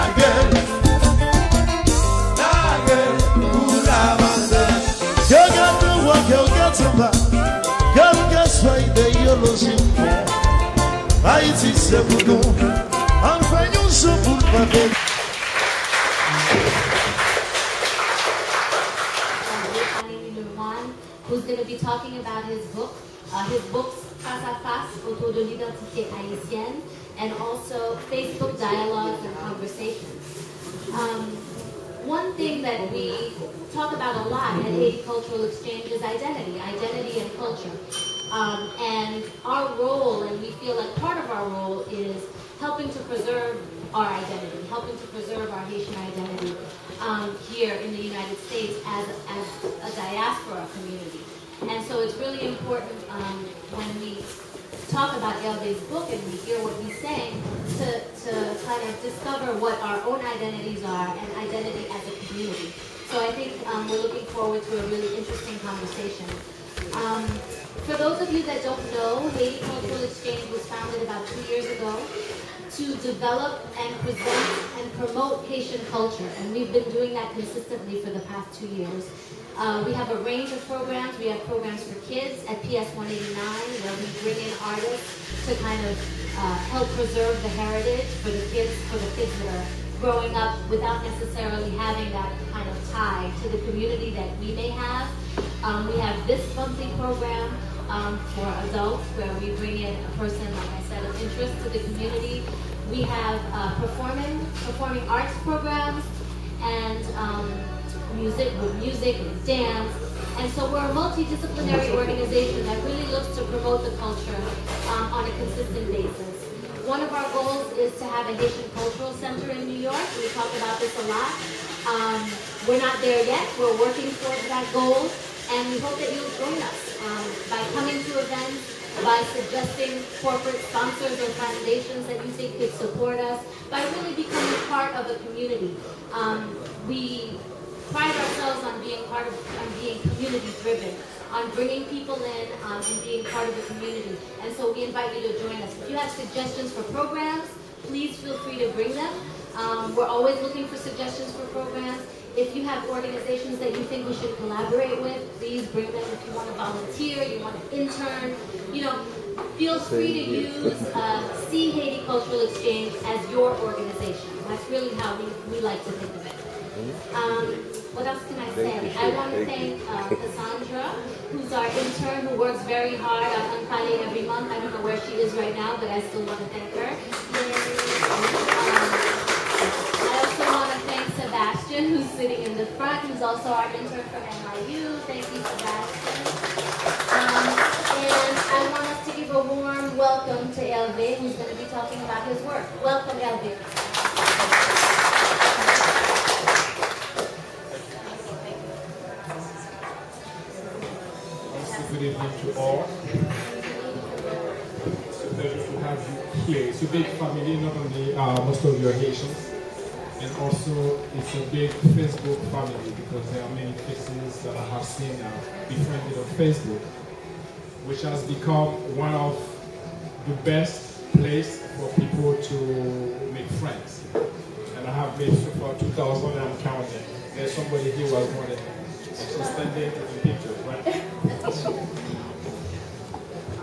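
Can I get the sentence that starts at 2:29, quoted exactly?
Um, we're always looking for suggestions for programs.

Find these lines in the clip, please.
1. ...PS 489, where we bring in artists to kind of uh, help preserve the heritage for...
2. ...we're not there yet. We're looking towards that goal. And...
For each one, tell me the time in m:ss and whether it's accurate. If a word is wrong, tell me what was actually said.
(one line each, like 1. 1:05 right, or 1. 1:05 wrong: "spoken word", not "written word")
1. 1:22 wrong: "189", not "489"
2. 2:02 wrong: "working", not "looking".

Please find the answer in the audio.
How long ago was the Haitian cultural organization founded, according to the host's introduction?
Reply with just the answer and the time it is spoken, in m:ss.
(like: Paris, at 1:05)
about two years ago, at 1:11.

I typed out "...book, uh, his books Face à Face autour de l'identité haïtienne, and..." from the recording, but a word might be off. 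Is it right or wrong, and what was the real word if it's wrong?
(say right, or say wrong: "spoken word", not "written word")
right.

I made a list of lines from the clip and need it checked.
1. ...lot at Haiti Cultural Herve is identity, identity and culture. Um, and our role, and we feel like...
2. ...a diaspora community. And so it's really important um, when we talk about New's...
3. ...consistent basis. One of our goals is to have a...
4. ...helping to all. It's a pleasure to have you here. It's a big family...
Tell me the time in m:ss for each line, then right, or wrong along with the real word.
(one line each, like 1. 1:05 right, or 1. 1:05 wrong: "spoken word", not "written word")
1. 0:34 wrong: "Exchange", not "Herve"
2. 0:49 wrong: "Herve", not "New"
3. 1:55 right
4. 3:22 wrong: "evening", not "helping".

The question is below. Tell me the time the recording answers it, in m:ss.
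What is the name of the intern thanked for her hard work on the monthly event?
2:50.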